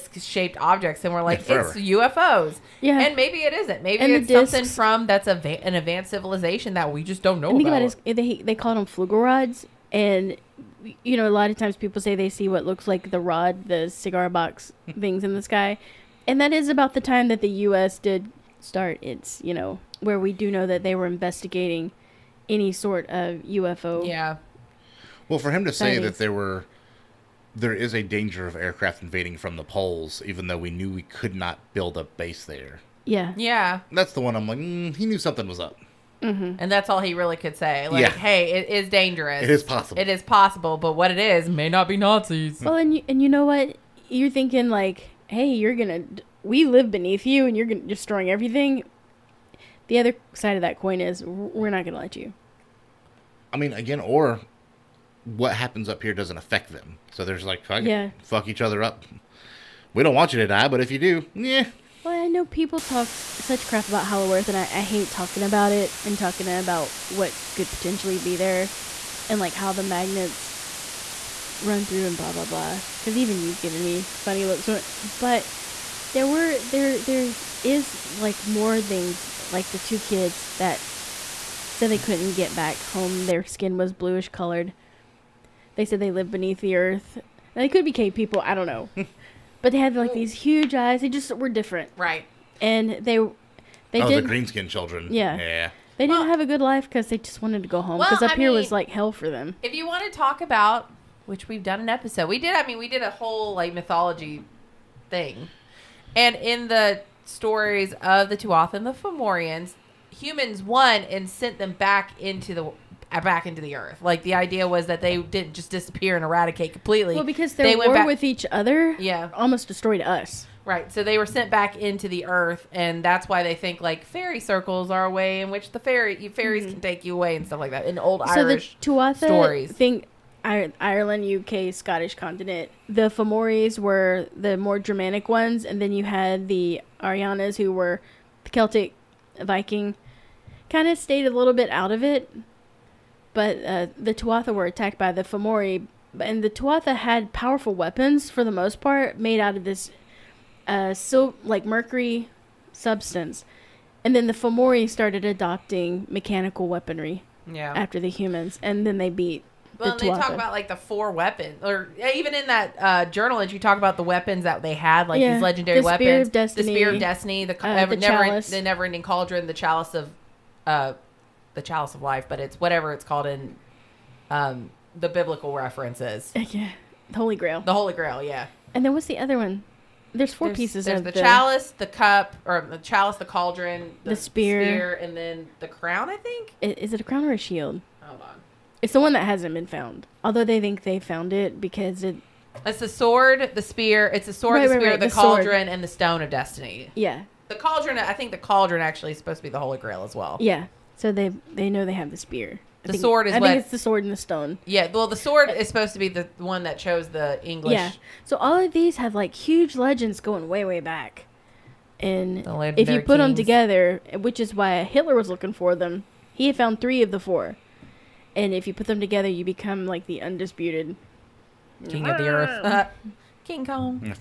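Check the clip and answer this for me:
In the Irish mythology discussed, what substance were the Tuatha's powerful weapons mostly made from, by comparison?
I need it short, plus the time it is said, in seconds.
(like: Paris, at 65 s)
Mercury, at 151 s.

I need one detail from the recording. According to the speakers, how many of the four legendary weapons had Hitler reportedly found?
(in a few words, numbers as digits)
3.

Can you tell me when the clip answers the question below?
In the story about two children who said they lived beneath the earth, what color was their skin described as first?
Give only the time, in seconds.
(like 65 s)
83 s.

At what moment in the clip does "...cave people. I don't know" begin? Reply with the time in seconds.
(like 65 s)
87 s.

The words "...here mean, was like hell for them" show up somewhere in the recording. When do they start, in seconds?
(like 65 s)
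98 s.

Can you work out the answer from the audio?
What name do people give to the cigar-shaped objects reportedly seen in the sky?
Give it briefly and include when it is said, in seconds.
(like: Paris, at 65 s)
Rods, at 8 s.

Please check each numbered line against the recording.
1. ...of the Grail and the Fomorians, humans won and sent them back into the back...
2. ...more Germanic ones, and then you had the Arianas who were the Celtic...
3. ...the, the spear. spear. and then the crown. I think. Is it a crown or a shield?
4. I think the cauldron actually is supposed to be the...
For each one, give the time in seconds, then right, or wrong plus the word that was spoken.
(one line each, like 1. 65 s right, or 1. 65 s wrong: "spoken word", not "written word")
1. 108 s wrong: "Tuatha", not "Grail"
2. 134 s right
3. 184 s right
4. 197 s right.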